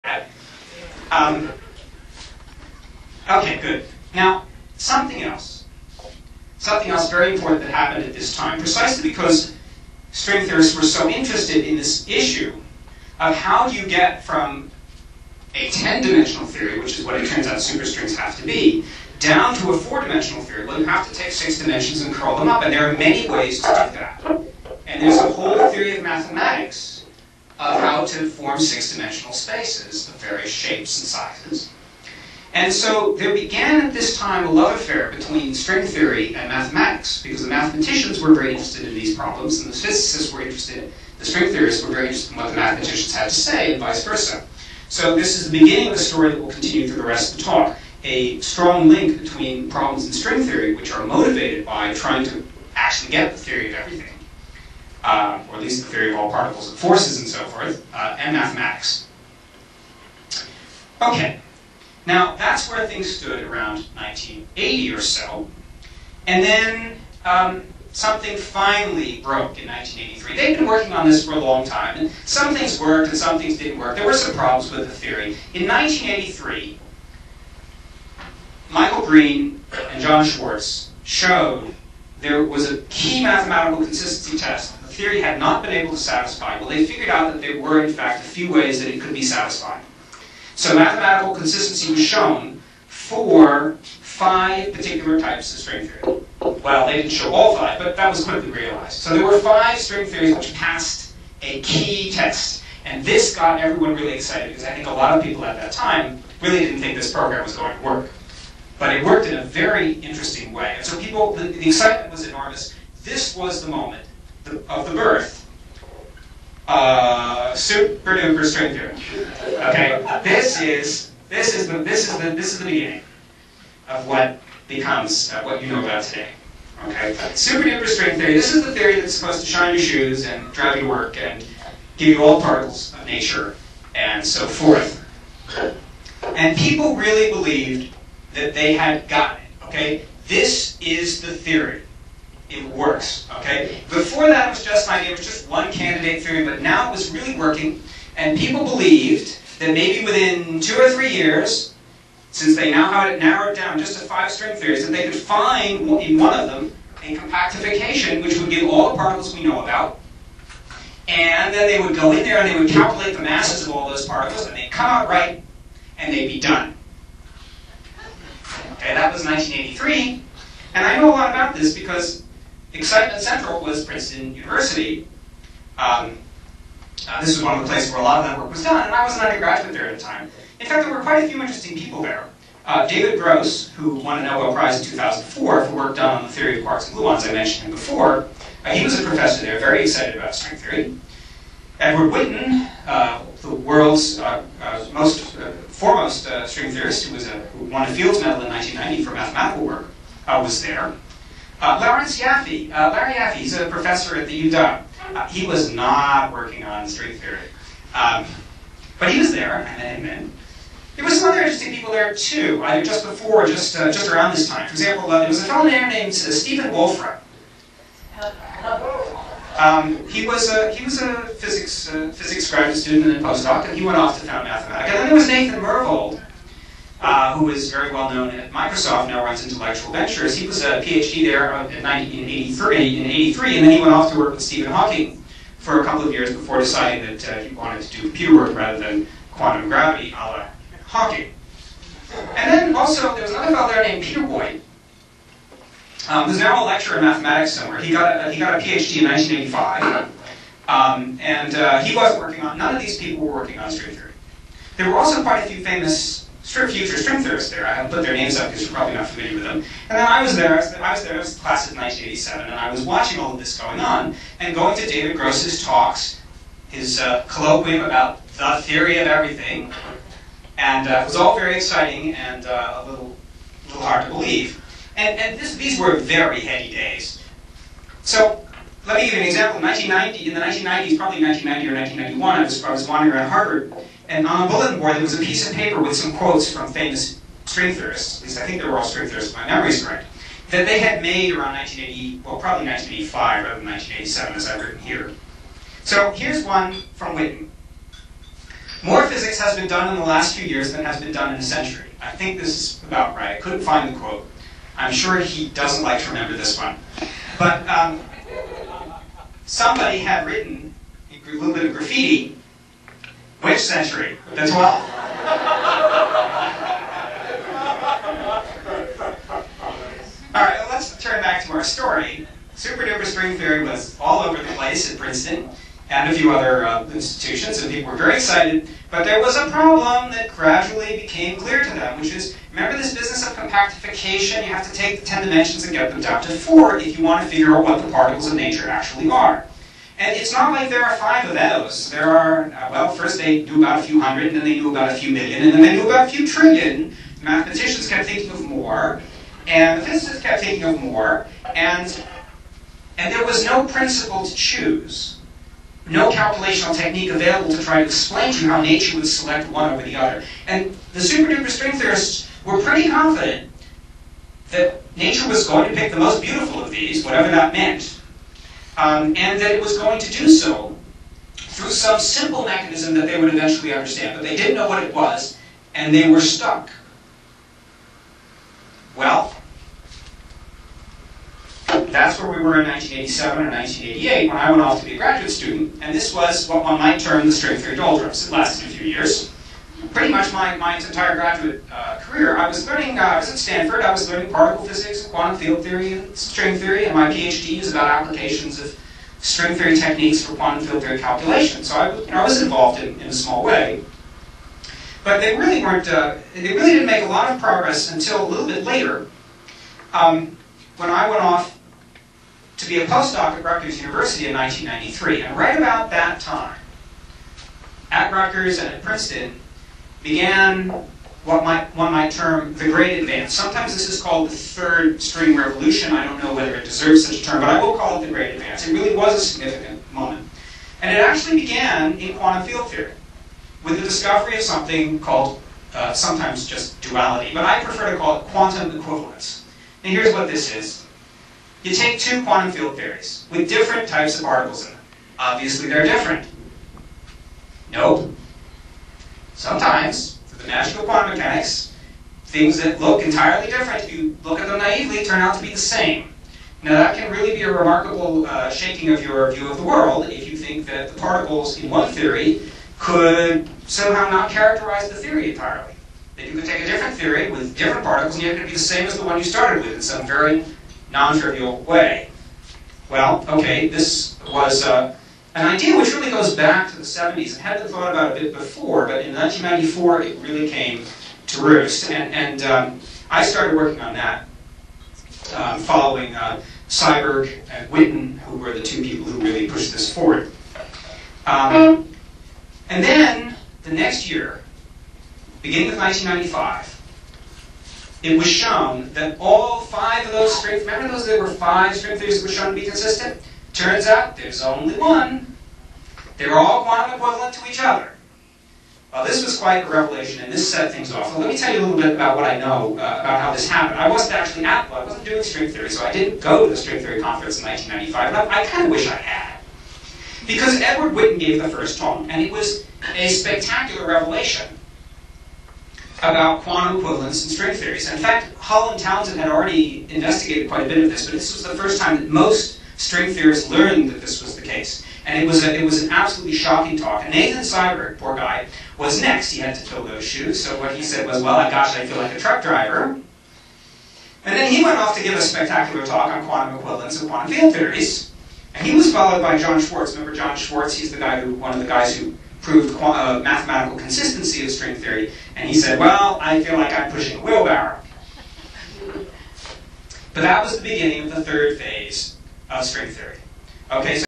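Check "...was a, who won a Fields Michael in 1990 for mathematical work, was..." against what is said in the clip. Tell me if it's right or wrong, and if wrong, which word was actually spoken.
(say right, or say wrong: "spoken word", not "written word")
wrong: "Medal", not "Michael".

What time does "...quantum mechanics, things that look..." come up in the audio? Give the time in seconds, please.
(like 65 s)
450 s.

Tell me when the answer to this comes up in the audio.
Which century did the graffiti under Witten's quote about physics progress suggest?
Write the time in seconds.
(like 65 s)
314 s.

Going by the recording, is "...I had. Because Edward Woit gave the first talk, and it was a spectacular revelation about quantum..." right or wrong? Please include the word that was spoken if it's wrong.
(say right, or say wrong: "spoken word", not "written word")
wrong: "Witten", not "Woit".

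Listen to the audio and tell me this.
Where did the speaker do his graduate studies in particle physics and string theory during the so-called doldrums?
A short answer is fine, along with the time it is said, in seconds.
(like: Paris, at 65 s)
Stanford, at 393 s.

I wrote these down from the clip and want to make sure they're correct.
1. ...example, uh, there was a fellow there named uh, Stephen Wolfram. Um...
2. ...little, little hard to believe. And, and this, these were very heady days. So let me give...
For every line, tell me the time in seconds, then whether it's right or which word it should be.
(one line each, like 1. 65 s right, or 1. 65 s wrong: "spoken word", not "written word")
1. 214 s right
2. 272 s right.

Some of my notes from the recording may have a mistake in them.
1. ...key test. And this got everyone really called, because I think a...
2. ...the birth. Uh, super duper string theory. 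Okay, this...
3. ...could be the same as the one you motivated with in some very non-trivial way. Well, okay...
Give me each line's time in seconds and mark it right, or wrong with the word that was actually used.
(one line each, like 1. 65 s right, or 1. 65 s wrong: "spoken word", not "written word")
1. 101 s wrong: "excited", not "called"
2. 114 s right
3. 468 s wrong: "started", not "motivated".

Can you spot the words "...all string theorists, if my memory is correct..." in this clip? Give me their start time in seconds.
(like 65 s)
288 s.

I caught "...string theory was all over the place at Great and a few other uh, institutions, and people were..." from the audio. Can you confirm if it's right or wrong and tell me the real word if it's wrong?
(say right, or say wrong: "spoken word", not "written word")
wrong: "Princeton", not "Great".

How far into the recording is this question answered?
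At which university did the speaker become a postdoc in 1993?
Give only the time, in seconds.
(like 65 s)
413 s.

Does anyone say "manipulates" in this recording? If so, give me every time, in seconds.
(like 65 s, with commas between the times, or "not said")
not said.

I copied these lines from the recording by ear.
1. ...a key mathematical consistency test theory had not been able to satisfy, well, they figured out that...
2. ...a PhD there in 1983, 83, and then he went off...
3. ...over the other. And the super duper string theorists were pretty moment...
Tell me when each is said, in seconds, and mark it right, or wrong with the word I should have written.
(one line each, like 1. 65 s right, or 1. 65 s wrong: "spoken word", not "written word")
1. 82 s right
2. 230 s right
3. 359 s wrong: "confident", not "moment".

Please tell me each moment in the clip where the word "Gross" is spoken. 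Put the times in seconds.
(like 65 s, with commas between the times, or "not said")
183 s, 265 s.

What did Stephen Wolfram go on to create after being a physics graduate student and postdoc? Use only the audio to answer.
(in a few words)
Mathematica.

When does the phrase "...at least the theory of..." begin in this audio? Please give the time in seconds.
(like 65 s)
55 s.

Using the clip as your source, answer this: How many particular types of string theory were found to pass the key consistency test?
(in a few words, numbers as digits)
5.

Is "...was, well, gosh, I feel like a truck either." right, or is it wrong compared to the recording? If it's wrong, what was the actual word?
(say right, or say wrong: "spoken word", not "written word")
wrong: "driver", not "either".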